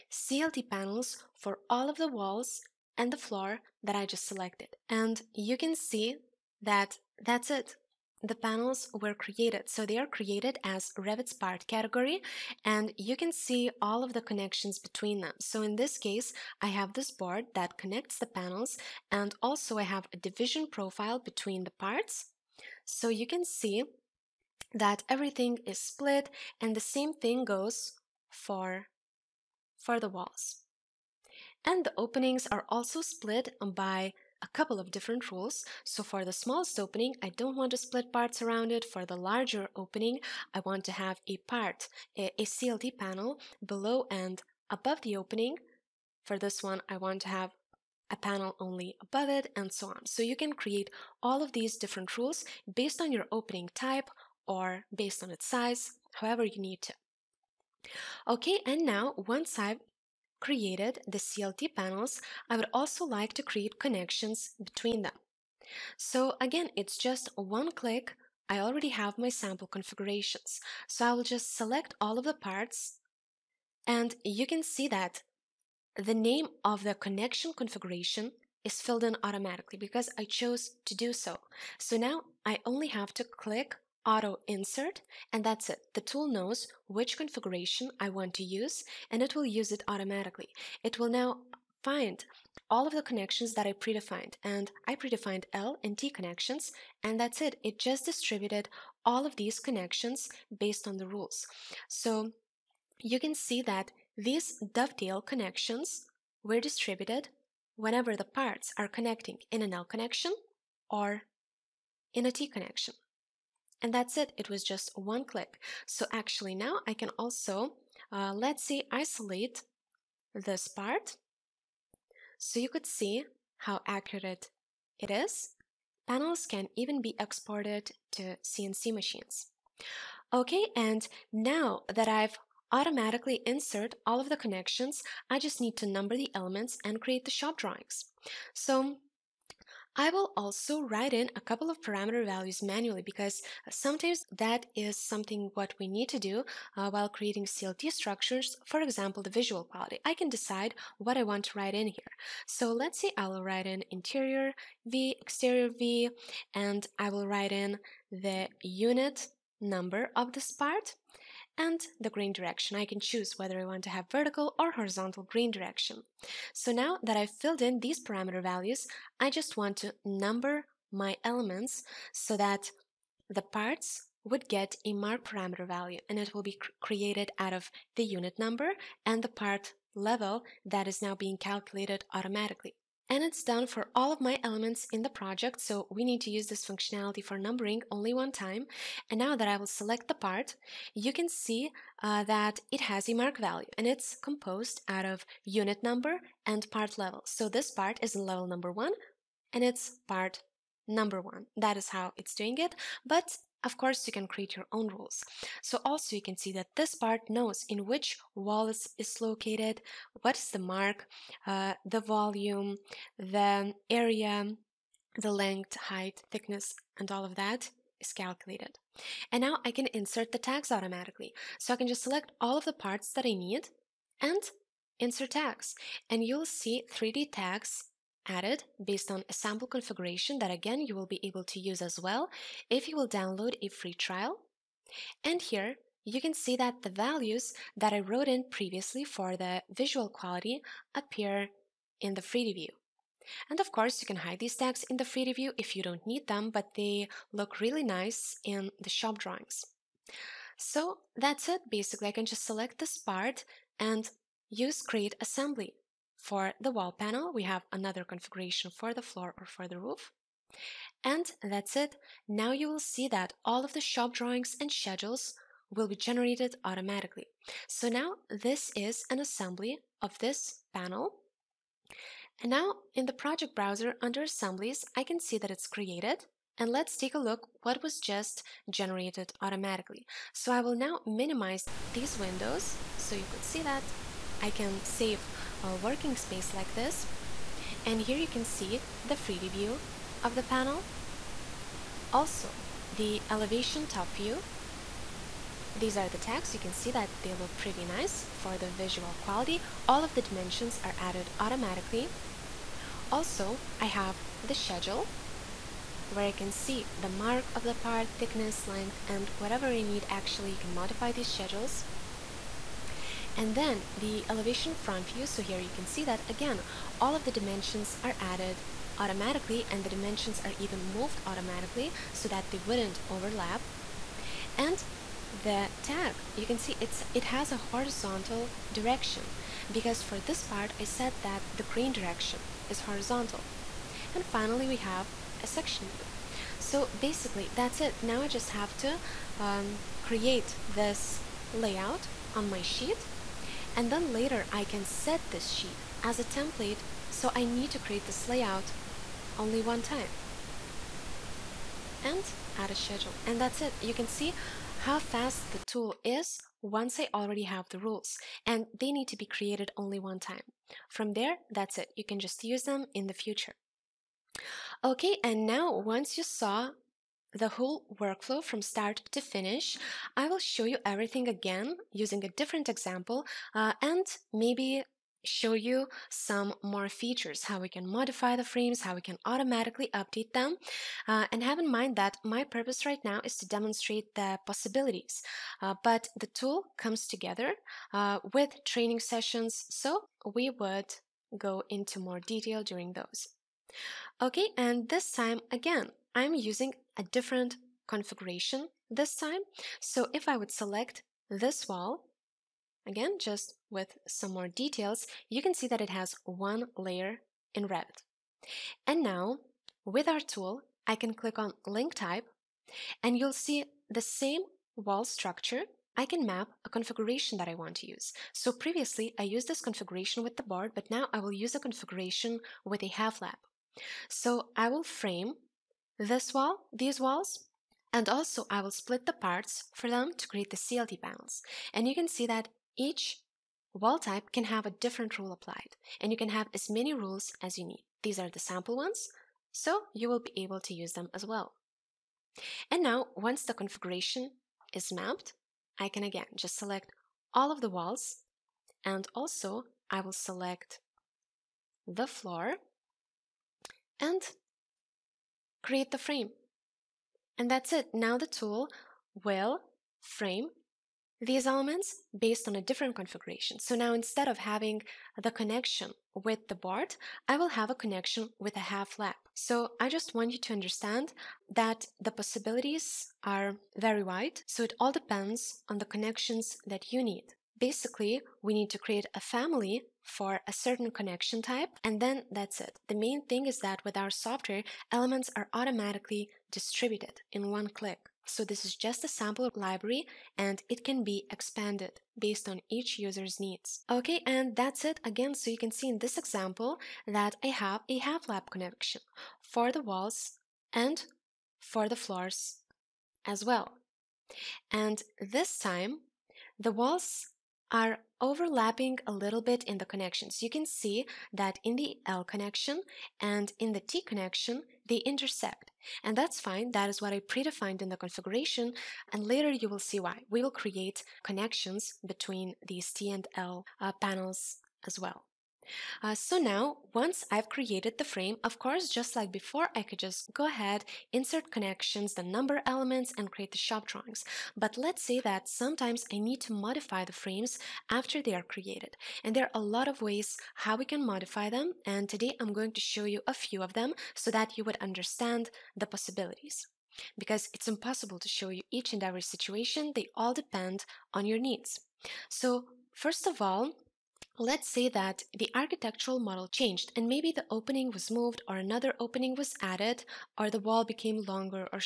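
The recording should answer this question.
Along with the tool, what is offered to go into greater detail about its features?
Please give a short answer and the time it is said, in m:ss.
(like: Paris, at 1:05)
Training sessions, at 6:28.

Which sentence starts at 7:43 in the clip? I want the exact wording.
So now instead of having the connection with the board, I will have a connection with a half lap.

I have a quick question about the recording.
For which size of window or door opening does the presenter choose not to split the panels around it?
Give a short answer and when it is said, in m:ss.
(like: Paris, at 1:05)
The smallest opening, at 0:36.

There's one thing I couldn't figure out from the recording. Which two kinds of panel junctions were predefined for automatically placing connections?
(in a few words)
L and T.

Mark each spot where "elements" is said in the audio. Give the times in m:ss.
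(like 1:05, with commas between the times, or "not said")
2:16, 2:51, 3:04, 7:41, 8:04, 8:52.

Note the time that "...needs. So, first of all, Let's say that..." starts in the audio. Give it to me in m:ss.
9:11.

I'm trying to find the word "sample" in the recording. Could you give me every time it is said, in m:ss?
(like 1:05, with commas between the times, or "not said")
1:09, 3:49, 7:18, 8:09.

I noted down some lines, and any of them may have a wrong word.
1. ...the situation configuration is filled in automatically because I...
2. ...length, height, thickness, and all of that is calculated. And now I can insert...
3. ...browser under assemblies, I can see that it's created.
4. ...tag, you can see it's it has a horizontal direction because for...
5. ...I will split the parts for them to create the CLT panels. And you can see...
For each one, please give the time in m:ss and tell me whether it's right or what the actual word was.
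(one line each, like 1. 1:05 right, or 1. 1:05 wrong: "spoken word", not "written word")
1. 1:16 wrong: "connection", not "situation"
2. 3:35 right
3. 4:33 right
4. 5:25 right
5. 7:08 right.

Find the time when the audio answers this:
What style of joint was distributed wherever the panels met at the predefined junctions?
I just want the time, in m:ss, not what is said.
1:44.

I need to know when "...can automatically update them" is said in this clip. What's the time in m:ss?
6:19.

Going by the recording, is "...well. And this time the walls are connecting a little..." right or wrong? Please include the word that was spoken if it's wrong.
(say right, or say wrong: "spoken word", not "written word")
wrong: "overlapping", not "connecting".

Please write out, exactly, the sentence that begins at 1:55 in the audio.
So actually now I can also, uh, let's say, isolate this part.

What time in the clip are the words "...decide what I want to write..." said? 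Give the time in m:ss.
2:30.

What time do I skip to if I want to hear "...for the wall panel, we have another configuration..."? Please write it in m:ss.
4:16.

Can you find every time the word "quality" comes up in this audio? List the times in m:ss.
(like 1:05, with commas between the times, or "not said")
2:29, 4:00, 4:59.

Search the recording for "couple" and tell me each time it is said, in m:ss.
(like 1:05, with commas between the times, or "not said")
0:34, 2:21.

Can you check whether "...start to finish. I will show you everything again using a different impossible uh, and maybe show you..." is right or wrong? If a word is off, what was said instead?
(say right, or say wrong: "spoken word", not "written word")
wrong: "example", not "impossible".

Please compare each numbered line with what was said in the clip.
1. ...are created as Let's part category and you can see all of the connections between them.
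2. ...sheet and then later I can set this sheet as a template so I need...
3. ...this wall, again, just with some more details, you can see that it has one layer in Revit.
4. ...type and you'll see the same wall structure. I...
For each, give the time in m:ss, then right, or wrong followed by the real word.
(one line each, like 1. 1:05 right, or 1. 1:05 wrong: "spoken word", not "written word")
1. 0:09 wrong: "Revit", not "Let"
2. 5:42 right
3. 6:41 right
4. 6:51 right.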